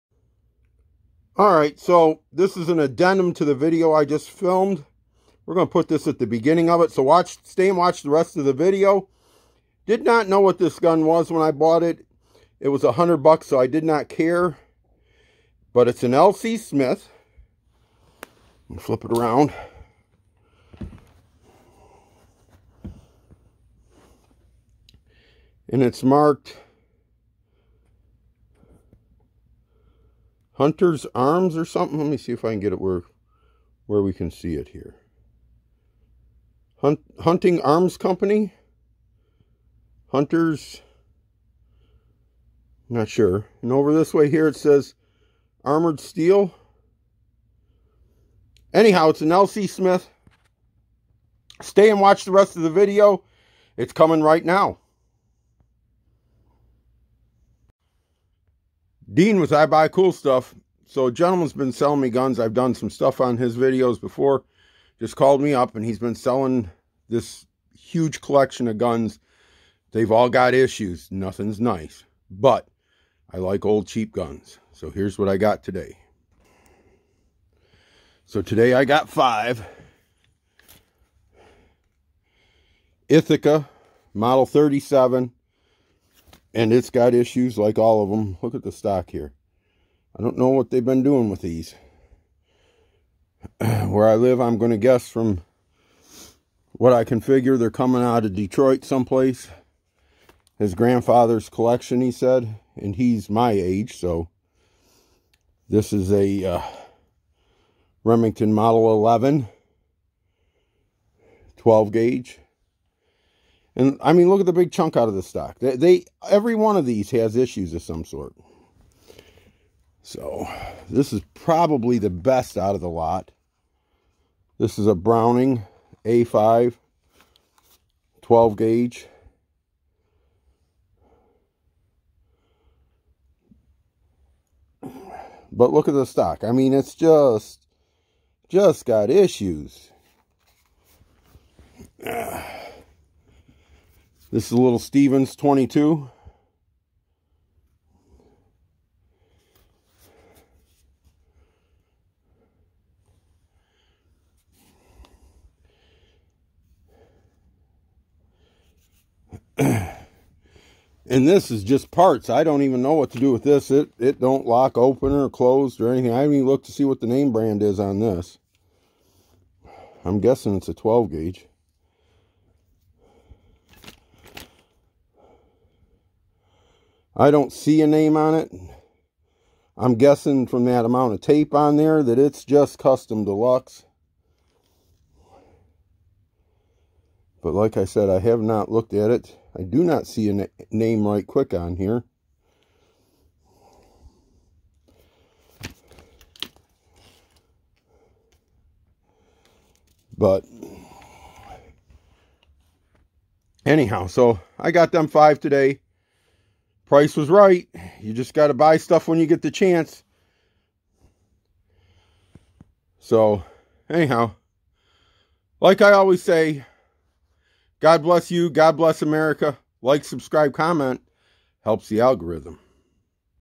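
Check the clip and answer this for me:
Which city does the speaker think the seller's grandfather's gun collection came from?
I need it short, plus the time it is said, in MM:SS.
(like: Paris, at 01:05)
Detroit, at 01:38.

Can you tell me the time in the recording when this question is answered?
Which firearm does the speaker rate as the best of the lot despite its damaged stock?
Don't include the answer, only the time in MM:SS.
02:04.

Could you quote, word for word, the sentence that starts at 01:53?
And I mean, look at the big chunk out of the stock.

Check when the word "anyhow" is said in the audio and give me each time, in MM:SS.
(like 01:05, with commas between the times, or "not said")
00:48, 03:23, 03:33.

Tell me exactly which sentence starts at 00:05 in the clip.
We're going to put this at the beginning of it.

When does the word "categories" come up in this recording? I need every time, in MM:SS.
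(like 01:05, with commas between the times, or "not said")
not said.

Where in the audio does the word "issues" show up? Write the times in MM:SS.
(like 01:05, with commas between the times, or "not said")
01:10, 01:27, 01:57, 02:19.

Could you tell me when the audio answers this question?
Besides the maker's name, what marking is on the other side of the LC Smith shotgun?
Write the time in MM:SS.
00:45.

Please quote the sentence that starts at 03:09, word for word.
I do not see a name right quick on here.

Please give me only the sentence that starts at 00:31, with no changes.
Let me see if I can get it where, where we can see it here.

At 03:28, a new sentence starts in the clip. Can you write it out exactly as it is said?
You just got to buy stuff when you get the chance.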